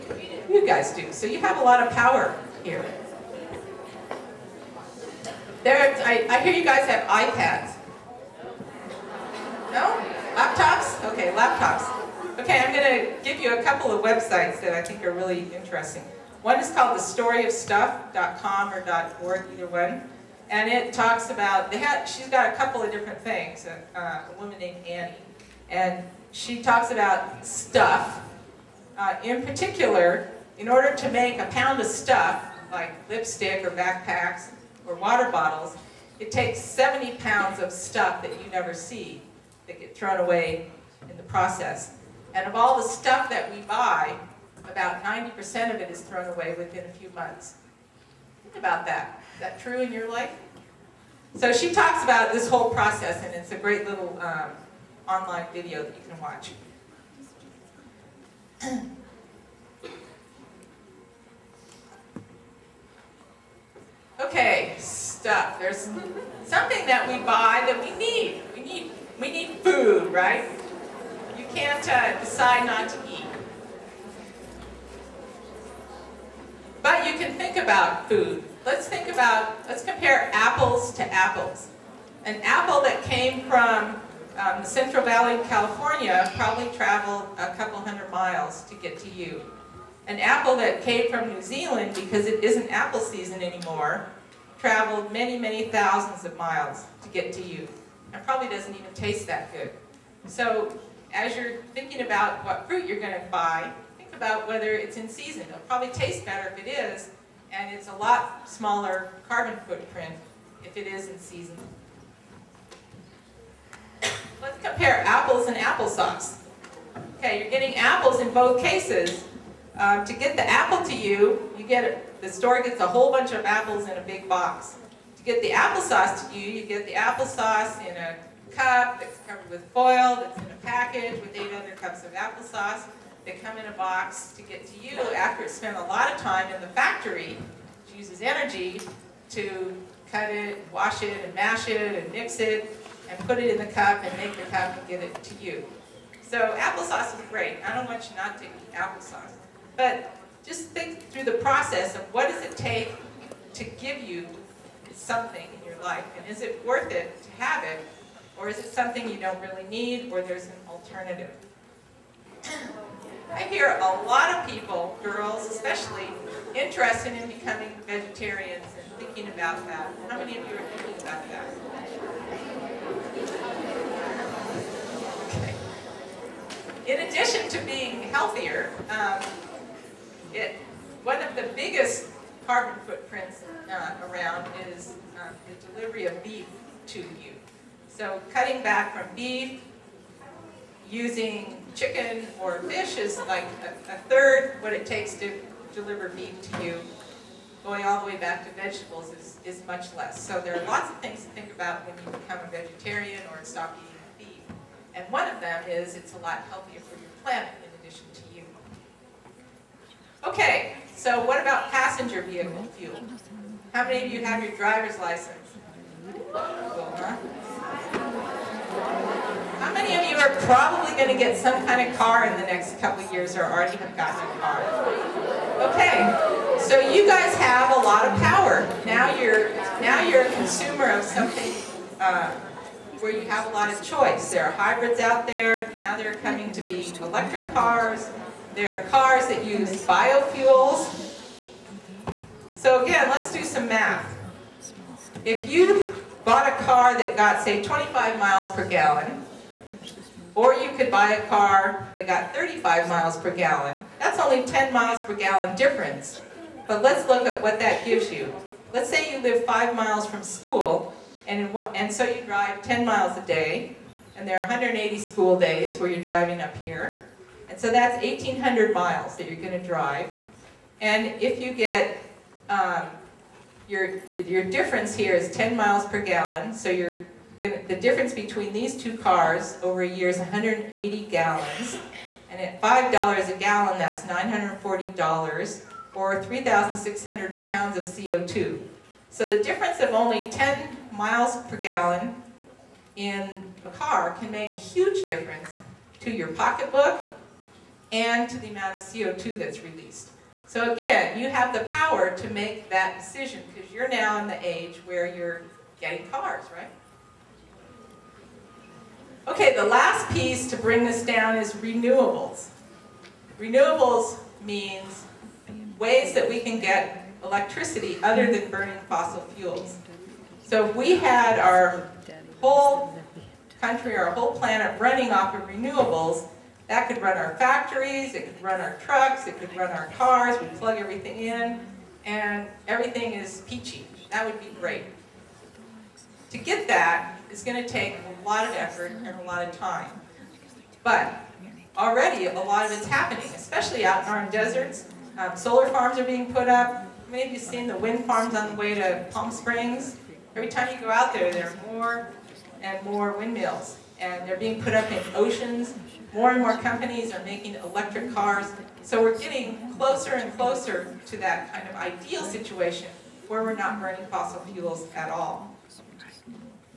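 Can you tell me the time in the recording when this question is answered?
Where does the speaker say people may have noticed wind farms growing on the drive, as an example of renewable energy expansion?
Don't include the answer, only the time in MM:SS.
05:49.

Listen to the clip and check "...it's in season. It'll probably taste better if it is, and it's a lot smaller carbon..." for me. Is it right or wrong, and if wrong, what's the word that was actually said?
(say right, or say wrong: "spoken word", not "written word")
right.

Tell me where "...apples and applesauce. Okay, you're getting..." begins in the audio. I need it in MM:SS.
01:55.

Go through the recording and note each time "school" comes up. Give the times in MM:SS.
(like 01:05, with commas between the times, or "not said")
04:20, 04:24.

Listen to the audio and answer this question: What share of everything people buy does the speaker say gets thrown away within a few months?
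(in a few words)
90%.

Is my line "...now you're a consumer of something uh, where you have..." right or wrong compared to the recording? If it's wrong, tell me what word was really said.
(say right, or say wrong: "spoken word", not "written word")
right.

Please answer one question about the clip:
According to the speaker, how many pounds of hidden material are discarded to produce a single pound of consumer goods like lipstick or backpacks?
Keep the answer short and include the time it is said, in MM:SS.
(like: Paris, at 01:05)
70 pounds, at 00:36.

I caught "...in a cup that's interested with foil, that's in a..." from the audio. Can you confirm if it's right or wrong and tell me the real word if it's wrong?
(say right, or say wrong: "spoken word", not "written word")
wrong: "covered", not "interested".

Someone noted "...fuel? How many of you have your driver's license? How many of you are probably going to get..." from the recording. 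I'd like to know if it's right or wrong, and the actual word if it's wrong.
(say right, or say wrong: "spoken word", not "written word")
right.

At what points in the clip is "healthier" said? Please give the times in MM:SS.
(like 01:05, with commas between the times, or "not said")
02:58, 03:26.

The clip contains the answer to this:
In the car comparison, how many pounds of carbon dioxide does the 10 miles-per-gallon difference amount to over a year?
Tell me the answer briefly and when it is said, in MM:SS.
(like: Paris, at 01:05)
3,600 pounds, at 04:46.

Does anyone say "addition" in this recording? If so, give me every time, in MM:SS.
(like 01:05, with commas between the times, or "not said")
02:57, 03:27.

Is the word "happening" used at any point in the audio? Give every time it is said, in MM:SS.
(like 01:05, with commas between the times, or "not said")
05:42.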